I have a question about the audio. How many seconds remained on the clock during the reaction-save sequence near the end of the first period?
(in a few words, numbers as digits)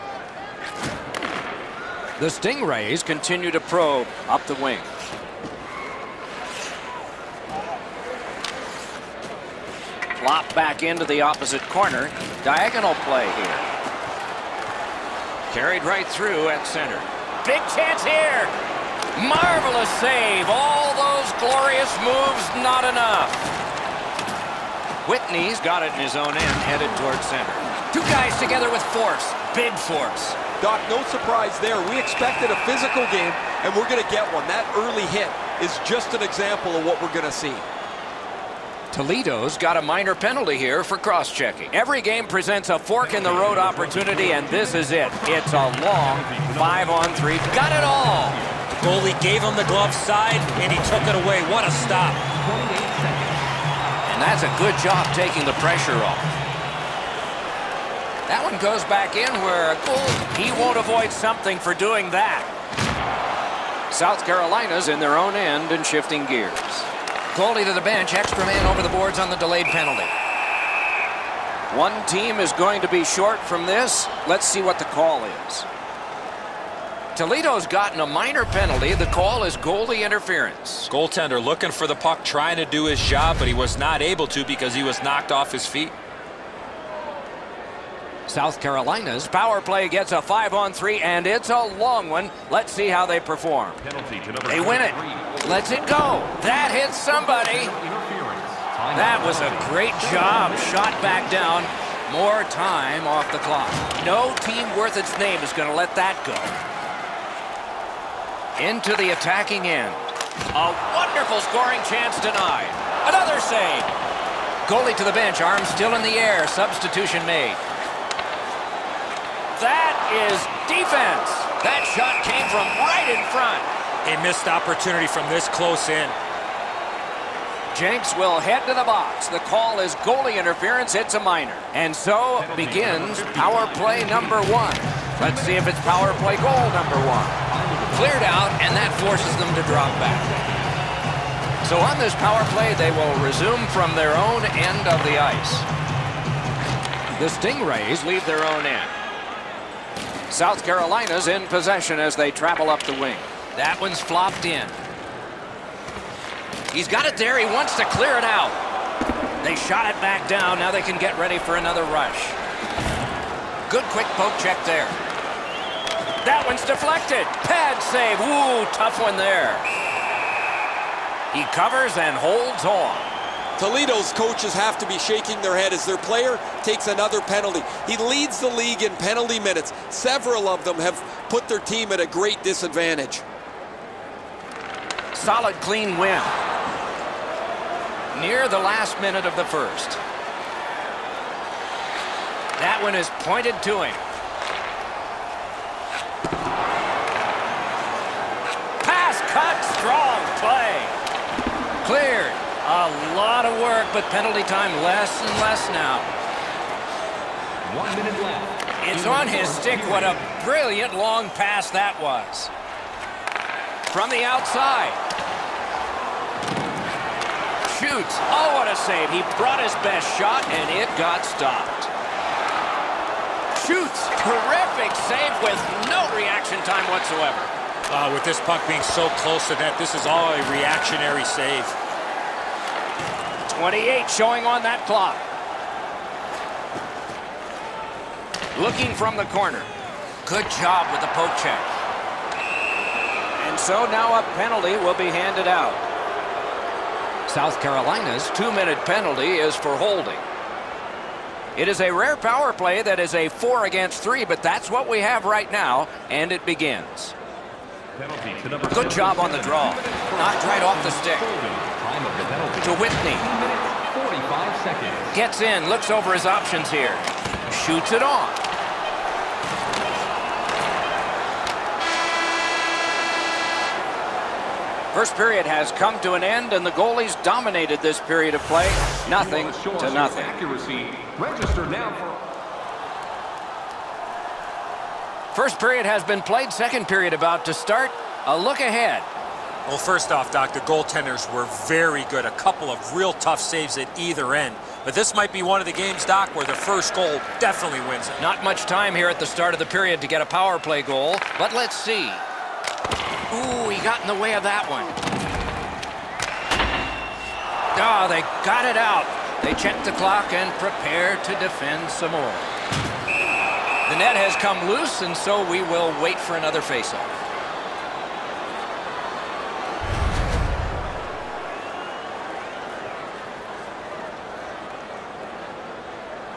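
28.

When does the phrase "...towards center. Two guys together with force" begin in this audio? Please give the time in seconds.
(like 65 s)
26 s.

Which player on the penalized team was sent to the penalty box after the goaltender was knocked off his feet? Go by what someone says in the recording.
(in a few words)
Jenks.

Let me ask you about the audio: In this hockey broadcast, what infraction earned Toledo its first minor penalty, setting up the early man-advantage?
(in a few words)
Cross-checking.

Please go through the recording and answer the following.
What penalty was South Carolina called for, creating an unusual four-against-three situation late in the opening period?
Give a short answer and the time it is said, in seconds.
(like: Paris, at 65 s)
Holding, at 249 s.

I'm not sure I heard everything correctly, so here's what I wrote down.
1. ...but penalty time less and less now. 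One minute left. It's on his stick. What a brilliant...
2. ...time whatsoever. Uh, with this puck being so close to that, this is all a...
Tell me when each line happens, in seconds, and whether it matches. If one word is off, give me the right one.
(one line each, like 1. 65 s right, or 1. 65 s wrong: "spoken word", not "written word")
1. 203 s right
2. 226 s right.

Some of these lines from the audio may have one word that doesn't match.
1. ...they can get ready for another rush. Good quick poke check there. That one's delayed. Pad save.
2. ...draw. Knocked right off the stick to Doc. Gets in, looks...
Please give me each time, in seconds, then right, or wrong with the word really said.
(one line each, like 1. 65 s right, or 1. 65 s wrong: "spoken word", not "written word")
1. 160 s wrong: "deflected", not "delayed"
2. 259 s wrong: "Whitney", not "Doc".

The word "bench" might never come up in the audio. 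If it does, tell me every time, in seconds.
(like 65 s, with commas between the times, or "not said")
67 s, 115 s.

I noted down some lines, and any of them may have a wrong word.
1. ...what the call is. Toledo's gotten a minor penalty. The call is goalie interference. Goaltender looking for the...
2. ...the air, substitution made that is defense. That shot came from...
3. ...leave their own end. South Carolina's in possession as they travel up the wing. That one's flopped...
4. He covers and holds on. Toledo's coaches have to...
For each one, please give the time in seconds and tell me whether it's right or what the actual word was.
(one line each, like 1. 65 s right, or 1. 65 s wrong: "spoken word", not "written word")
1. 74 s right
2. 116 s right
3. 148 s right
4. 171 s right.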